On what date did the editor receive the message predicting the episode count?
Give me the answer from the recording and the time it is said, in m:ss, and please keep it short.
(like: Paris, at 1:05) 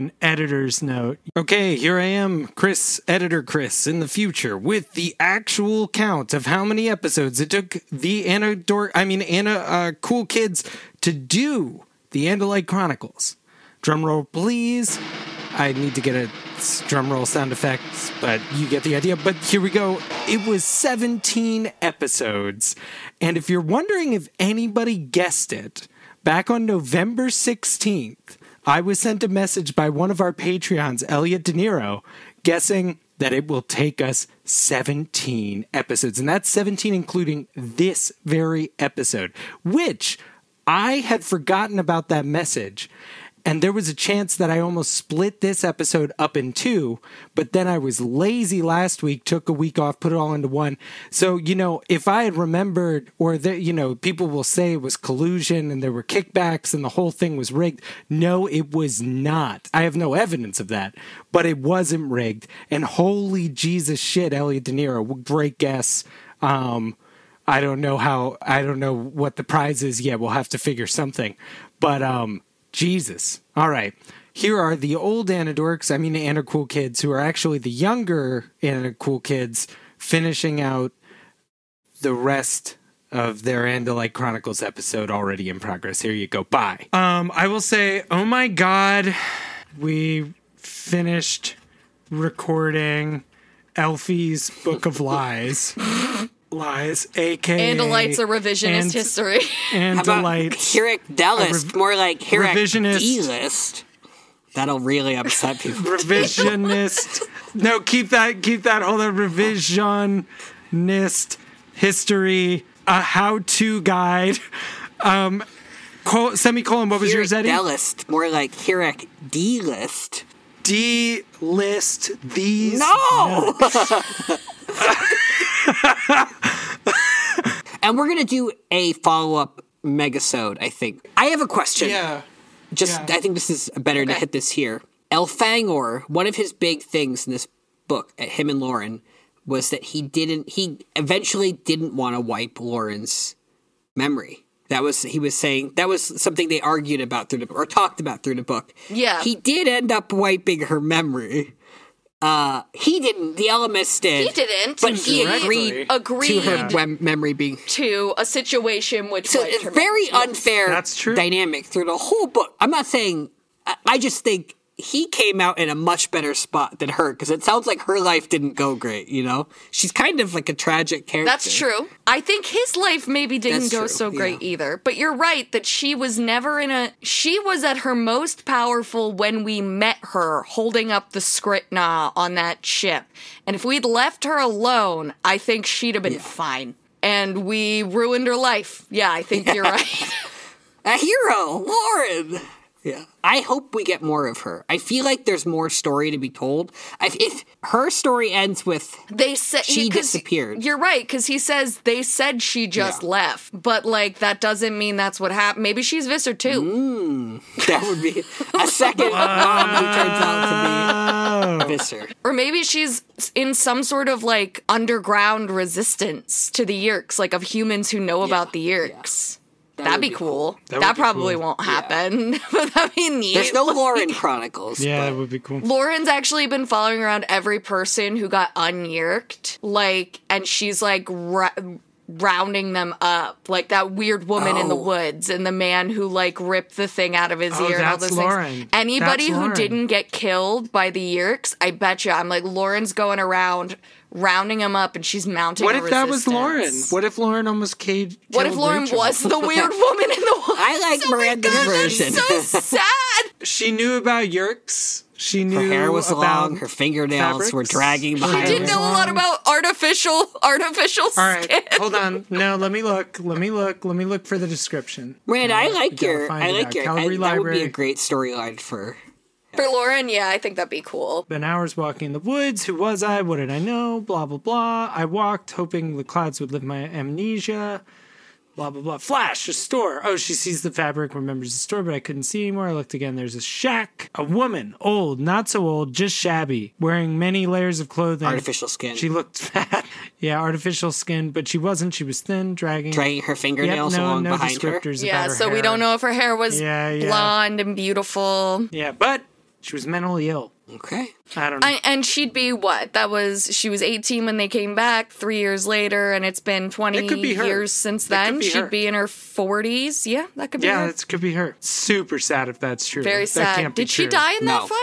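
November 16th, at 0:26.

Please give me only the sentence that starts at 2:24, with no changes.
That was he was saying that was something they argued about through the or talked about through the book.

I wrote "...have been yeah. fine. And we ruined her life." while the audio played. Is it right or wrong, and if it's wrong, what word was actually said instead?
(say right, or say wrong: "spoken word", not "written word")
right.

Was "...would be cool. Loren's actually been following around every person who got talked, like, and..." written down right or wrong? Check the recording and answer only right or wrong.
wrong.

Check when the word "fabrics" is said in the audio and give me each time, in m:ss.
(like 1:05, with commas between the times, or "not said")
4:17, 4:40.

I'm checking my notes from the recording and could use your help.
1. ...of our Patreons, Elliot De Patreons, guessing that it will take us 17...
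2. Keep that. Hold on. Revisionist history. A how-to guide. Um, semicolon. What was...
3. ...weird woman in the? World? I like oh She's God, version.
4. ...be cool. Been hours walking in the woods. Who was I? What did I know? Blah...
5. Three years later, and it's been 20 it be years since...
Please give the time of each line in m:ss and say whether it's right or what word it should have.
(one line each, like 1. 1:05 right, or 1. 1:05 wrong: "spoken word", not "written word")
1. 0:30 wrong: "Niro", not "Patreons"
2. 1:48 right
3. 4:09 wrong: "Miranda", not "She"
4. 4:30 right
5. 5:05 right.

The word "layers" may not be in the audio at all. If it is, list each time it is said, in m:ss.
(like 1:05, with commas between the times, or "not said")
4:47.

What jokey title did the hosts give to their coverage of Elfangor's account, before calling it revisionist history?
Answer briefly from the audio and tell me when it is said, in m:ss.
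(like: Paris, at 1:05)
Elfie's Book of Lies, at 1:33.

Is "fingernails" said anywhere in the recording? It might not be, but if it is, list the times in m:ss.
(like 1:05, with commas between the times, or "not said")
4:16, 4:53.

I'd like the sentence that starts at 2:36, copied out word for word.
memory being to a situation which so it's very unfair.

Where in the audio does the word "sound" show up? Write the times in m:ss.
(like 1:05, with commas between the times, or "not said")
0:17, 2:47.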